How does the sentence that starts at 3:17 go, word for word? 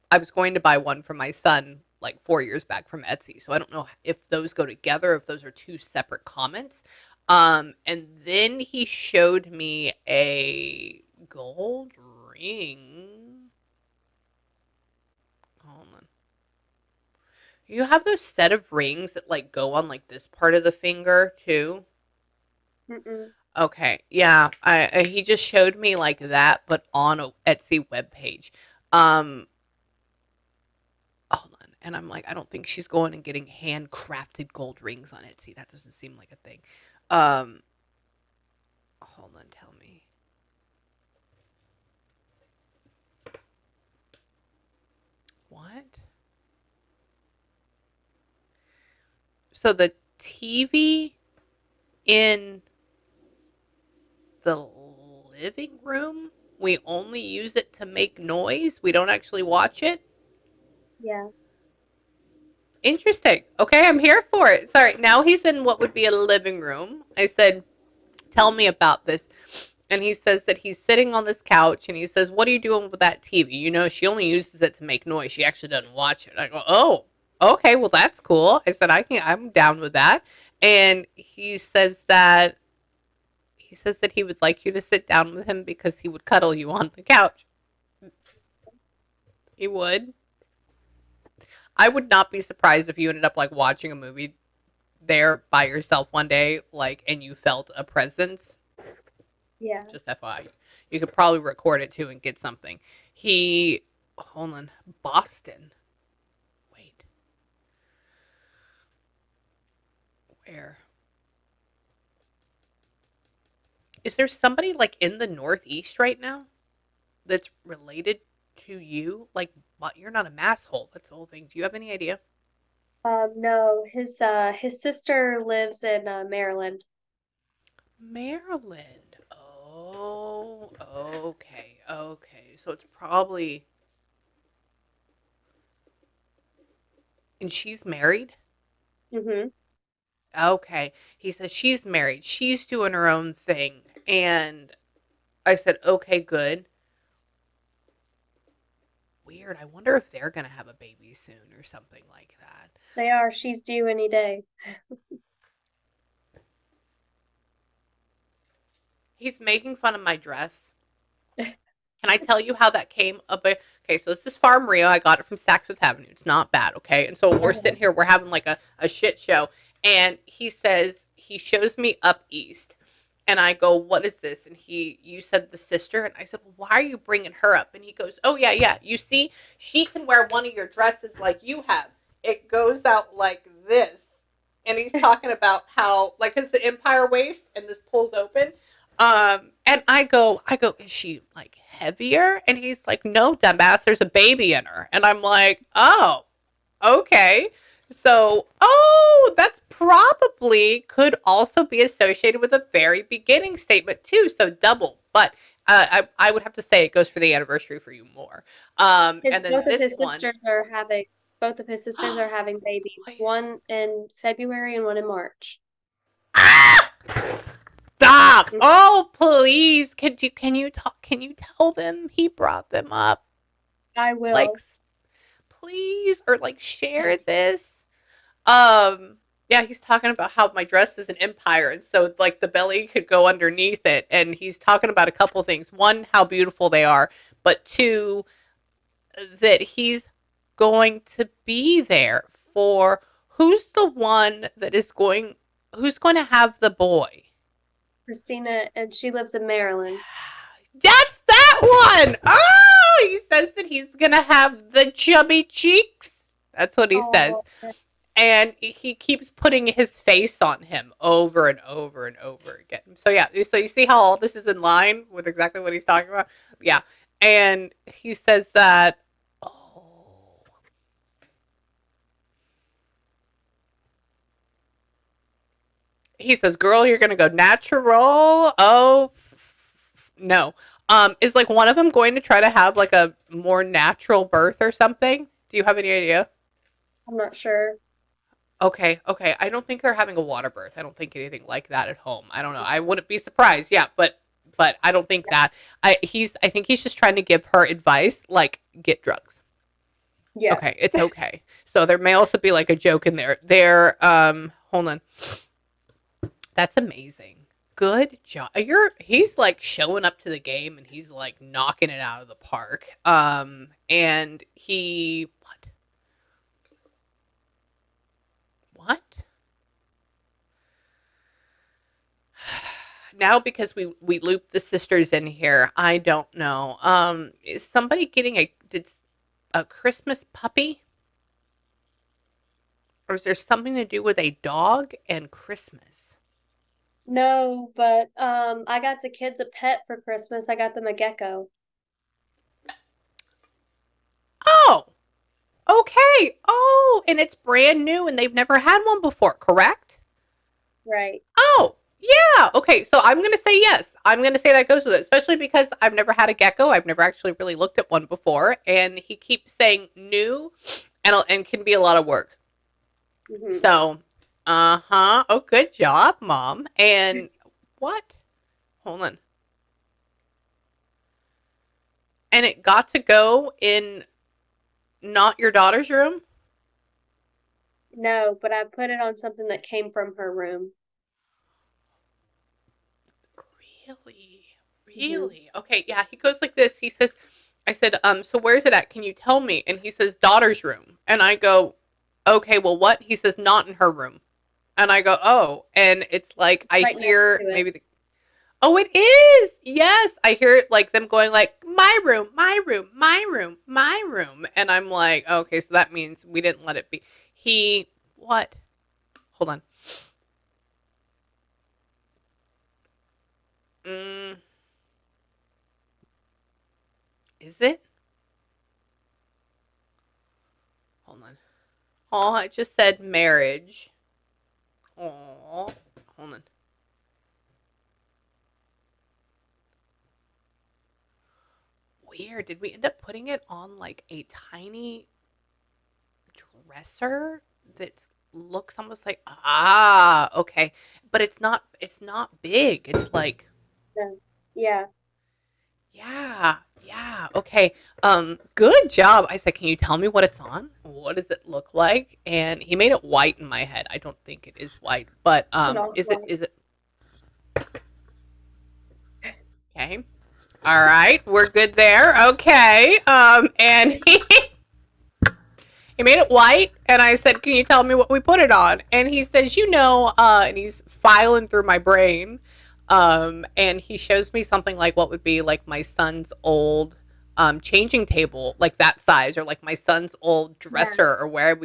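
So, oh, that's probably could also be associated with a very beginning statement too.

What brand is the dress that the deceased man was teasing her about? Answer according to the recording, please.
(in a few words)
Farm Rio.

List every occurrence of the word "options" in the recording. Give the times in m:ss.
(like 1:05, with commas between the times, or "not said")
not said.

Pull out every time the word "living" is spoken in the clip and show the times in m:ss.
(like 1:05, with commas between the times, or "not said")
0:55, 1:06.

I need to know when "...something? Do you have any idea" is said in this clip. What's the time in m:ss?
4:44.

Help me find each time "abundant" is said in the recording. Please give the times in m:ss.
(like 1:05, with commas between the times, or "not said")
not said.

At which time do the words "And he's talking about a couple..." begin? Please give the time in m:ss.
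3:54.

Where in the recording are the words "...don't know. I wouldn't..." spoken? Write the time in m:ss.
4:52.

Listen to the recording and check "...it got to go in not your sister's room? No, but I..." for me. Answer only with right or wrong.
wrong.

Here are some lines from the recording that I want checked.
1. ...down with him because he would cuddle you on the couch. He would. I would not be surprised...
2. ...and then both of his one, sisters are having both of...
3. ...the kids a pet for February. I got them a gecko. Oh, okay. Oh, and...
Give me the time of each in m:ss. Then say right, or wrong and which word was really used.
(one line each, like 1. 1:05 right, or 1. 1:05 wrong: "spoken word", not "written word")
1. 1:25 right
2. 3:29 right
3. 5:39 wrong: "Christmas", not "February".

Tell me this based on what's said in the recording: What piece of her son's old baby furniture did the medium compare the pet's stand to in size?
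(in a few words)
Changing table.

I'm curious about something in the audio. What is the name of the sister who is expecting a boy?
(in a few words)
Christina.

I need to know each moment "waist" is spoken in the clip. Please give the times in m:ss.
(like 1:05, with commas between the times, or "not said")
3:07.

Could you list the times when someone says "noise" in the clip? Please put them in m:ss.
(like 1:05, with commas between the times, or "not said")
0:58, 1:15.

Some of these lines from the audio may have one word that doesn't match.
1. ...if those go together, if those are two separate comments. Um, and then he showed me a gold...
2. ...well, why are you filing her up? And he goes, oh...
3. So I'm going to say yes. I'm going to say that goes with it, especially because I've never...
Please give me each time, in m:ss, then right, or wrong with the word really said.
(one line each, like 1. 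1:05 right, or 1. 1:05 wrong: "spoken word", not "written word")
1. 0:04 right
2. 2:56 wrong: "bringing", not "filing"
3. 5:52 right.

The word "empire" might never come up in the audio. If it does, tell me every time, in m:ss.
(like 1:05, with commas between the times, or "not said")
3:06, 3:51.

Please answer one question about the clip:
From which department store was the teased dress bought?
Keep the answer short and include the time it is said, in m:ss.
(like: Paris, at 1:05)
Saks Fifth Avenue, at 2:45.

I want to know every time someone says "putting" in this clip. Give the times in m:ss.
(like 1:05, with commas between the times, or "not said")
4:19, 7:13.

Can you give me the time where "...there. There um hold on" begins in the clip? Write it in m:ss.
5:03.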